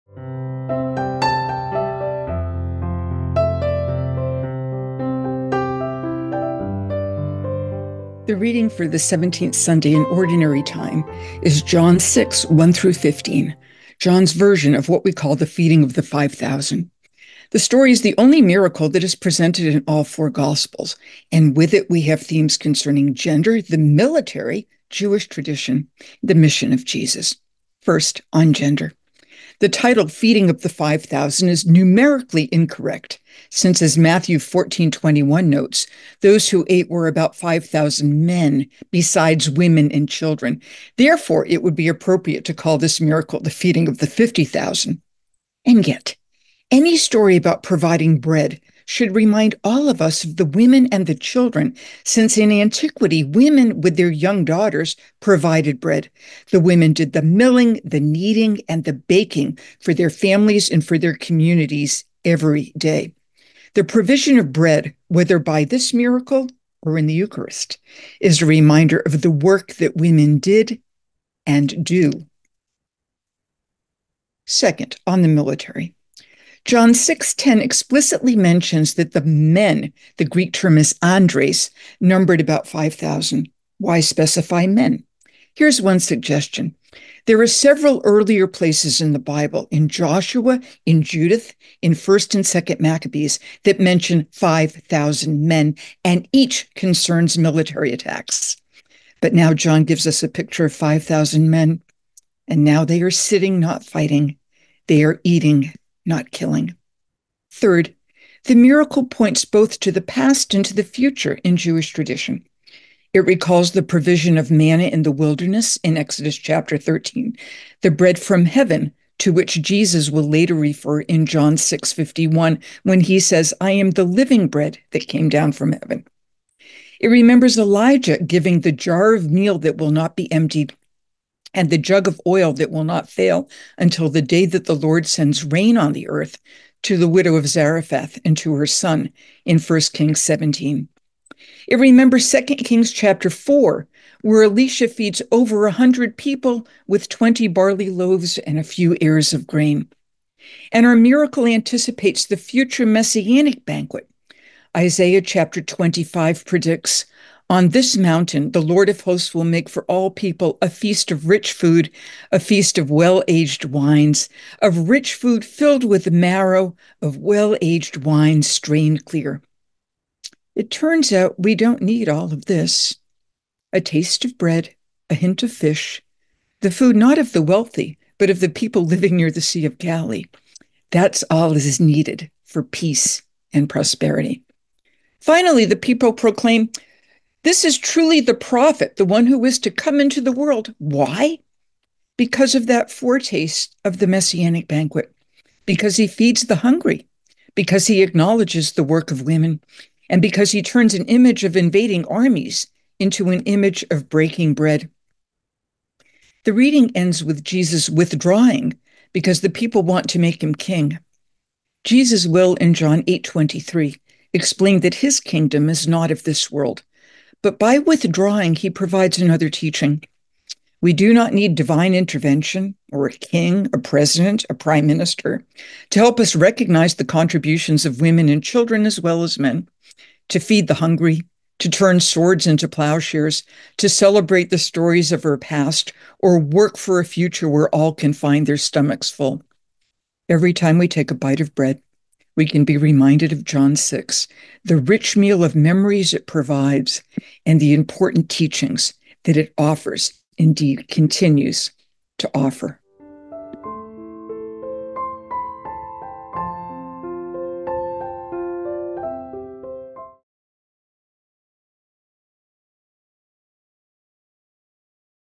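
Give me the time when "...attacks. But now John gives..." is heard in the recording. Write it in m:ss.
1:37.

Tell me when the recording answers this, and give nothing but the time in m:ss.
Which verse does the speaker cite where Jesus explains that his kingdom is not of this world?
3:32.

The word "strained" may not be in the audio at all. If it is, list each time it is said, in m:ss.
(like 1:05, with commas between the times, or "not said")
2:48.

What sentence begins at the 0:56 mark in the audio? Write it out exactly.
The women did the milling, the kneading, and the baking for their families and for their communities every day.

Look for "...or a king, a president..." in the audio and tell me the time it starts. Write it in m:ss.
3:42.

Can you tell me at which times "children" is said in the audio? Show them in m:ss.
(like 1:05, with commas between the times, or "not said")
0:40, 0:51, 3:48.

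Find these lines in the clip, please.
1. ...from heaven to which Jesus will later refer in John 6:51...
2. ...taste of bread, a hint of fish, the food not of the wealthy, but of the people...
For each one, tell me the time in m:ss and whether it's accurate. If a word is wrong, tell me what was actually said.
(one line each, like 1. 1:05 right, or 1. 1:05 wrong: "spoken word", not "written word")
1. 1:58 right
2. 2:53 right.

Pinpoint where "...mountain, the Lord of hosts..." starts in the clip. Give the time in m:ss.
2:37.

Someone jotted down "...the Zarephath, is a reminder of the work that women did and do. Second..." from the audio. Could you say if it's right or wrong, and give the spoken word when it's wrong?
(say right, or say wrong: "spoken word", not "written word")
wrong: "Eucharist", not "Zarephath".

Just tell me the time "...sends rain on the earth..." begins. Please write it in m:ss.
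2:15.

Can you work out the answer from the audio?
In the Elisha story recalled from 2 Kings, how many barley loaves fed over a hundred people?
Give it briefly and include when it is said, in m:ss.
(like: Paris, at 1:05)
20, at 2:27.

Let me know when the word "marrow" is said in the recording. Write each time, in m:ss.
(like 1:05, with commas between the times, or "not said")
2:46.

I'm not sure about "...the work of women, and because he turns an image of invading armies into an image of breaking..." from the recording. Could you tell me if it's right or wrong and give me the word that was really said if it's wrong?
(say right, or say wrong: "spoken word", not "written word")
right.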